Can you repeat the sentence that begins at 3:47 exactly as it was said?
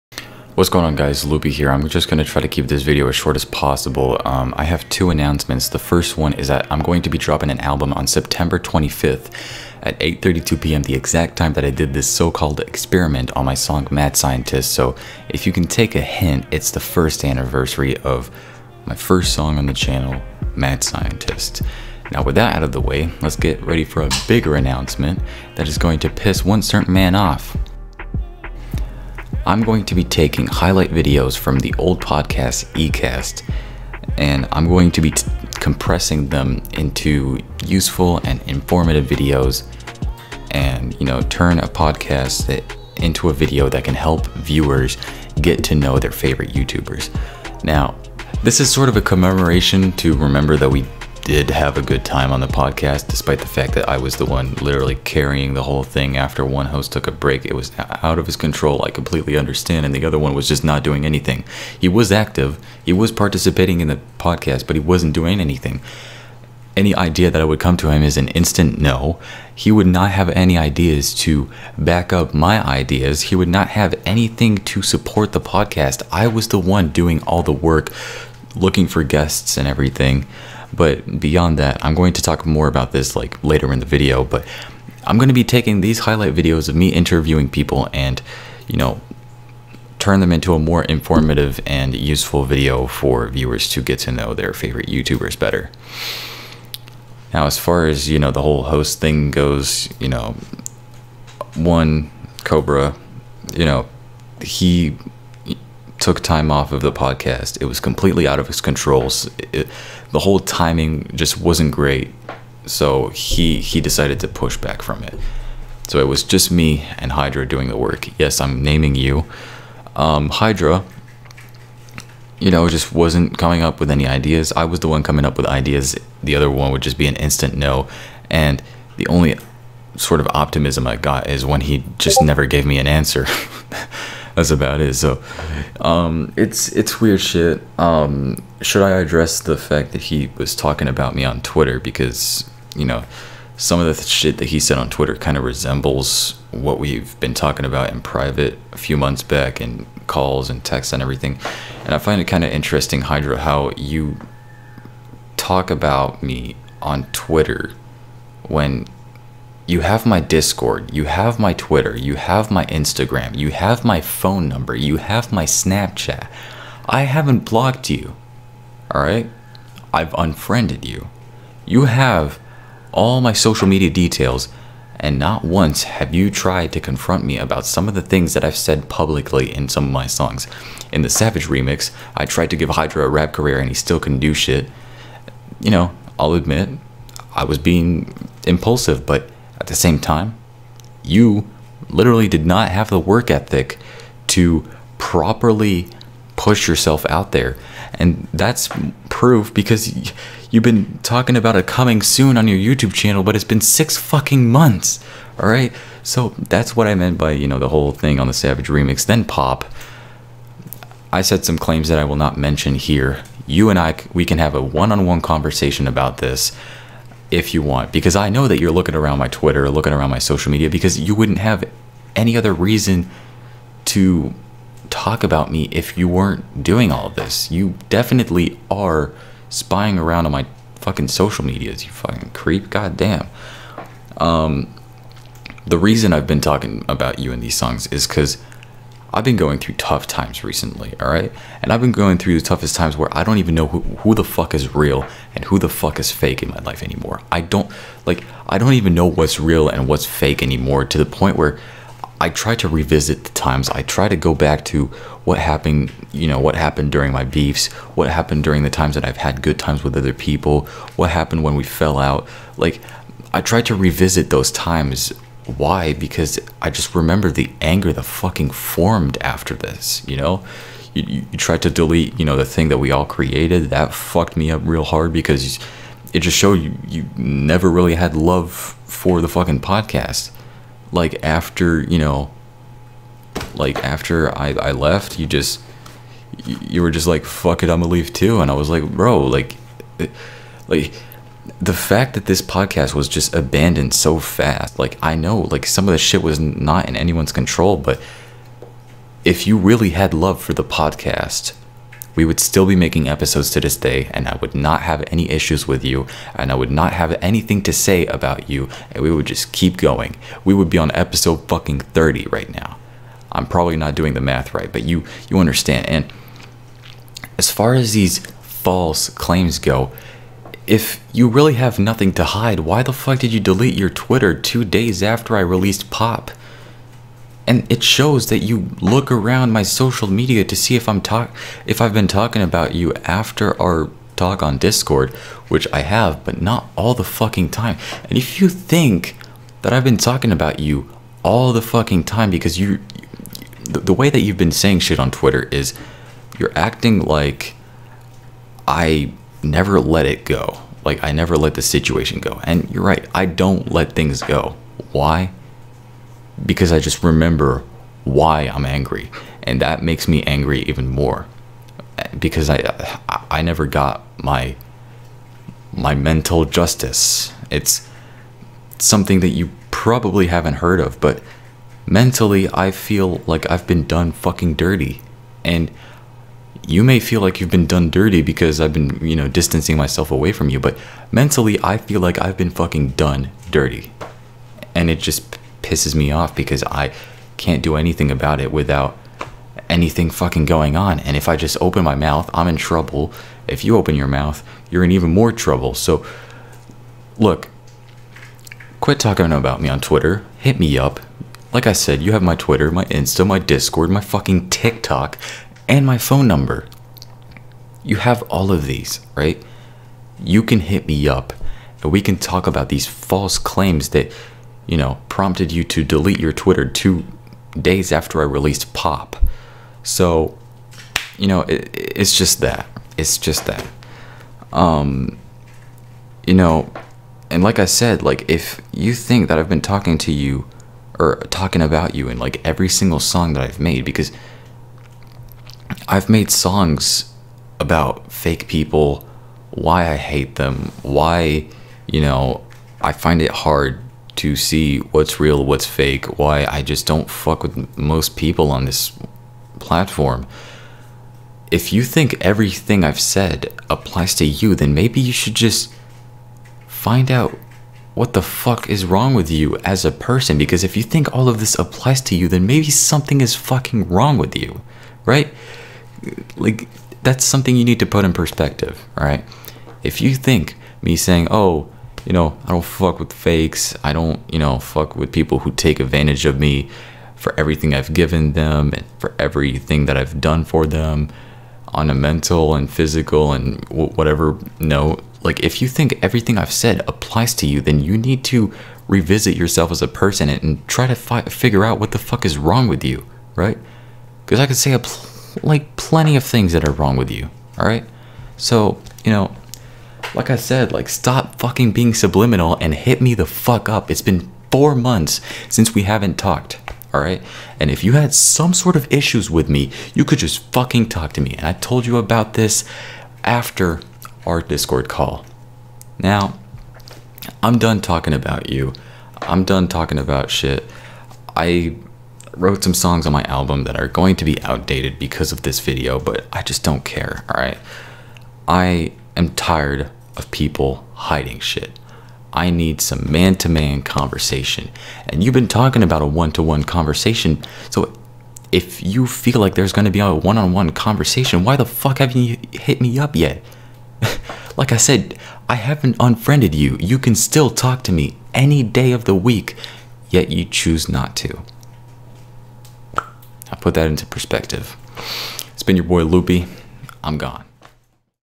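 You definitely are spying around on my fucking social medias, you fucking creep.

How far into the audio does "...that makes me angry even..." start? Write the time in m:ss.
5:59.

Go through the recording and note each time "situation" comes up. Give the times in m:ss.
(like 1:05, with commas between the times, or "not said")
5:51.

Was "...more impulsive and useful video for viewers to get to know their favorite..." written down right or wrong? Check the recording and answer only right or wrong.
wrong.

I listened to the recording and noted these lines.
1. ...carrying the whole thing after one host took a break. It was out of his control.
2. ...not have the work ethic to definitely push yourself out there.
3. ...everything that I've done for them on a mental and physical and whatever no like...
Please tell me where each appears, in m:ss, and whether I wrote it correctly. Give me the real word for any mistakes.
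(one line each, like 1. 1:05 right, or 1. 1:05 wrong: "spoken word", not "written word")
1. 0:54 right
2. 3:12 wrong: "properly", not "definitely"
3. 7:59 right.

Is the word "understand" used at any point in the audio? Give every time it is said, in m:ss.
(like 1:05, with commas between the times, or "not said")
0:59, 5:15.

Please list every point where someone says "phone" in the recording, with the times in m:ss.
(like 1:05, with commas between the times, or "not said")
2:44, 6:45.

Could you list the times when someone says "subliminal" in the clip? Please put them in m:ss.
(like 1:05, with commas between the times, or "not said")
8:21.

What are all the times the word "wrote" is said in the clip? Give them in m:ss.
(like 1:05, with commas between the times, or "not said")
8:42.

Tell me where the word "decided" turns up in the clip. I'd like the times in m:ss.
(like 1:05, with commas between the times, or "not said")
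1:53.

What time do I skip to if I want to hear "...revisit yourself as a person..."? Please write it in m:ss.
8:08.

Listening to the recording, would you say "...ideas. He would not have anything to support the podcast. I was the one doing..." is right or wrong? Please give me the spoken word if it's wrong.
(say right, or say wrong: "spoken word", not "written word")
right.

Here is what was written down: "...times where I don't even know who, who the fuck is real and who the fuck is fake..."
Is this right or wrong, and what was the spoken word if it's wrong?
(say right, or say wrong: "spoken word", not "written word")
right.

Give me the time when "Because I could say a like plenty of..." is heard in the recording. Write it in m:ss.
8:14.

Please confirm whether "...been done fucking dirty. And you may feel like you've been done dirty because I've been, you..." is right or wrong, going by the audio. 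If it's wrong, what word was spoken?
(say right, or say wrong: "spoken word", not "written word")
right.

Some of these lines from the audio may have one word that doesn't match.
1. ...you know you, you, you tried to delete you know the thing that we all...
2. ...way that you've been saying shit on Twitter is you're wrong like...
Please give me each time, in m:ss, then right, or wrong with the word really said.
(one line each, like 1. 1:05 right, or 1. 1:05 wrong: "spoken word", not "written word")
1. 4:30 right
2. 5:43 wrong: "acting", not "wrong".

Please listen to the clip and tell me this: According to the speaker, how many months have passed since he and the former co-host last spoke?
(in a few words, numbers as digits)
4.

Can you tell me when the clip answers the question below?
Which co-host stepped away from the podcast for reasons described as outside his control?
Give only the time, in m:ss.
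1:42.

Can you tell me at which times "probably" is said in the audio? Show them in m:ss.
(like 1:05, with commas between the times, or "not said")
5:13, 6:09.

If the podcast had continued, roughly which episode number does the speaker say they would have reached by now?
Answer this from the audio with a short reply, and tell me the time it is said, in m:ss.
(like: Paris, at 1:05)
30, at 5:11.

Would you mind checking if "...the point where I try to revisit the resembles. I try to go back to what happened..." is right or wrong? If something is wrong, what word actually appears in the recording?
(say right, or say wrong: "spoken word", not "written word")
wrong: "times", not "resembles".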